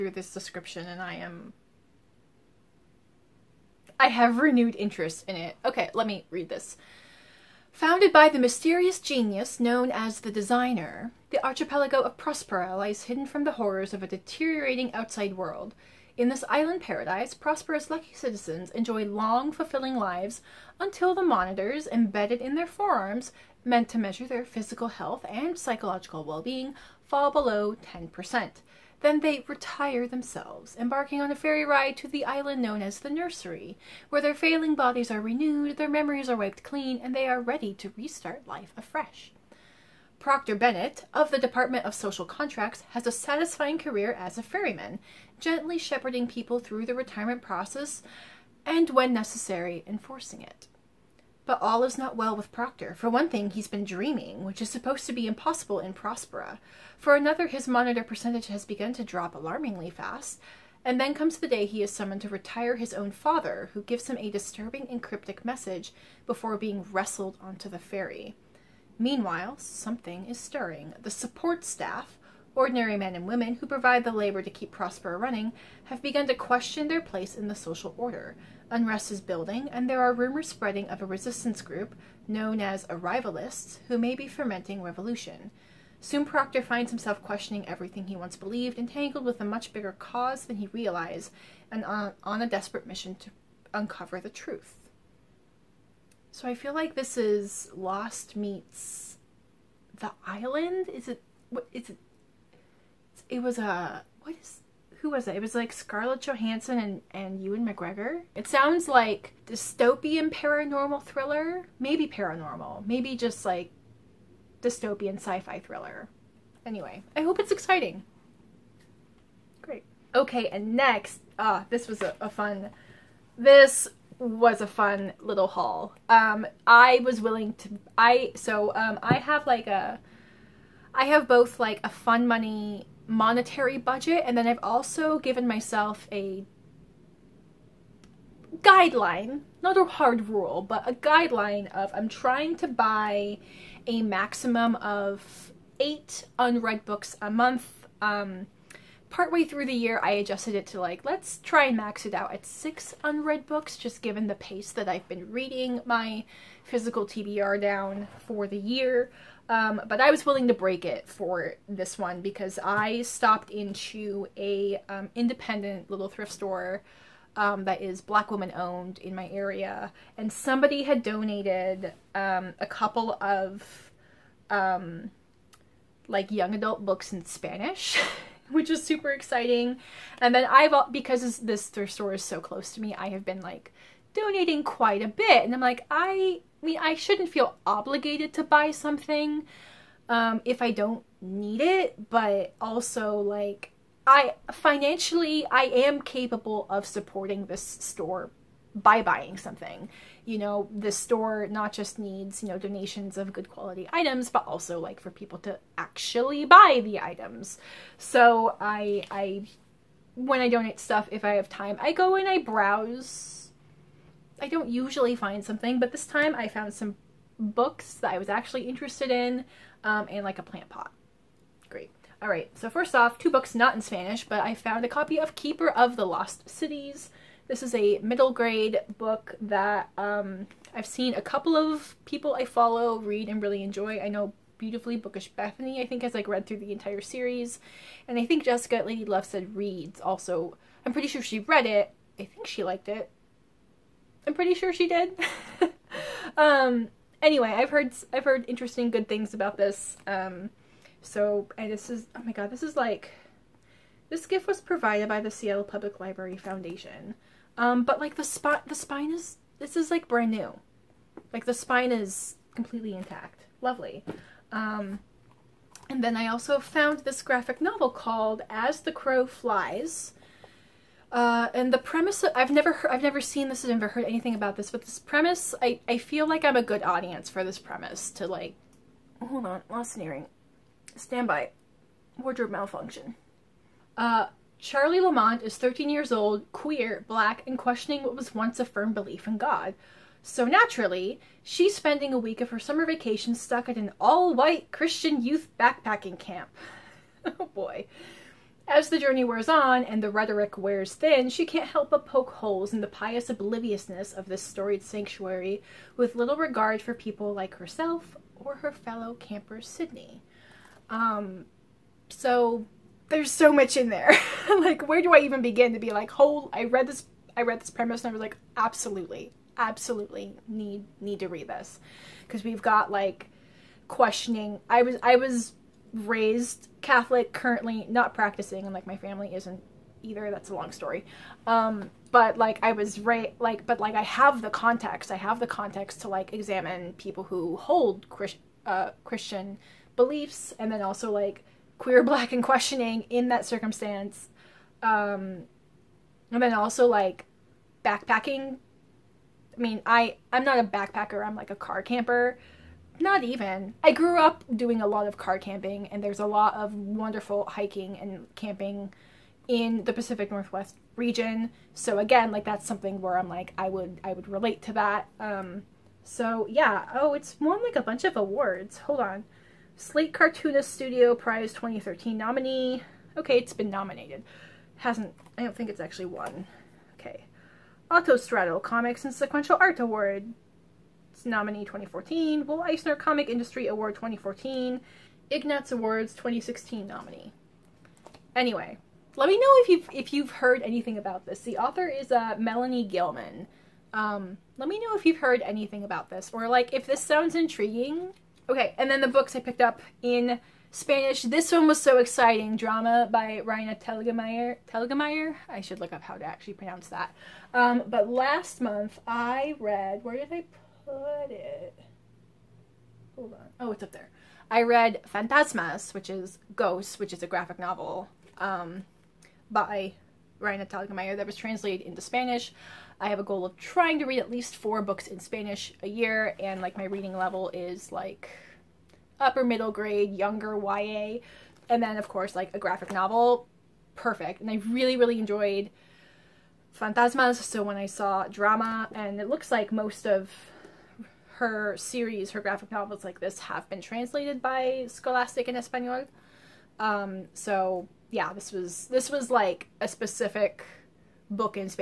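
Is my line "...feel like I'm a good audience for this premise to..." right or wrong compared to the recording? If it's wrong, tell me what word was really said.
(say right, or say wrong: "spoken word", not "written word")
right.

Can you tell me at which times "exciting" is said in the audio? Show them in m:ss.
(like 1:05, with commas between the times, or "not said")
1:57, 2:59, 6:41.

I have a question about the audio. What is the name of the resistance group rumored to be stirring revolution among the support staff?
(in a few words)
Arrivalists.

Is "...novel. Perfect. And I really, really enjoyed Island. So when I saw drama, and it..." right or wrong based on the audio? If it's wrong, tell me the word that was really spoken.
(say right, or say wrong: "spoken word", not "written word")
wrong: "Fantasmas", not "Island".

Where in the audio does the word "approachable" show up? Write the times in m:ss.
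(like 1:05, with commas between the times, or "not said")
not said.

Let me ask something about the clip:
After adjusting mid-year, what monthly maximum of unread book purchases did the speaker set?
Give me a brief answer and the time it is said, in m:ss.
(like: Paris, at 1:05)
6, at 2:32.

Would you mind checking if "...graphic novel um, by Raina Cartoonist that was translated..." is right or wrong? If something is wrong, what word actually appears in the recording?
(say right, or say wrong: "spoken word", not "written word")
wrong: "Telgemeier", not "Cartoonist".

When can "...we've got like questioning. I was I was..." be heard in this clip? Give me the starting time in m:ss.
5:22.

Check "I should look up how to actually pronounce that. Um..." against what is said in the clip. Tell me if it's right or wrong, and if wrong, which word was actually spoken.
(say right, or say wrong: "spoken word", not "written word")
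right.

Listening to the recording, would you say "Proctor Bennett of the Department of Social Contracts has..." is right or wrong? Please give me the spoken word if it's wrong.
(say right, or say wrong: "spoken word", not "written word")
right.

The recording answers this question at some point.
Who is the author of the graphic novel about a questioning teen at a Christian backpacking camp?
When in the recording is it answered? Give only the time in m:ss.
6:32.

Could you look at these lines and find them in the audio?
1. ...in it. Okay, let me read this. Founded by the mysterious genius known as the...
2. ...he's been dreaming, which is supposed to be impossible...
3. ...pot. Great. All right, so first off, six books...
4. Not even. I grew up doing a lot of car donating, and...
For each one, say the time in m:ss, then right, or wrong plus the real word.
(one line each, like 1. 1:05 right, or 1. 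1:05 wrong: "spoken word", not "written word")
1. 0:05 right
2. 0:53 right
3. 3:40 wrong: "two", not "six"
4. 5:52 wrong: "camping", not "donating".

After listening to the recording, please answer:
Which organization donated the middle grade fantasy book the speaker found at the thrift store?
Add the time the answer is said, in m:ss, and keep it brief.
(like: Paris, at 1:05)
Seattle Public Library Foundation, at 4:15.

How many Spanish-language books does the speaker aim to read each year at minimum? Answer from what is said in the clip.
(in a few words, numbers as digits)
4.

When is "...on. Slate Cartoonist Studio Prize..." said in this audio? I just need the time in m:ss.
6:08.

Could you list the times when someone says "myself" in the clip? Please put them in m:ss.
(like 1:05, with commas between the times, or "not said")
2:15.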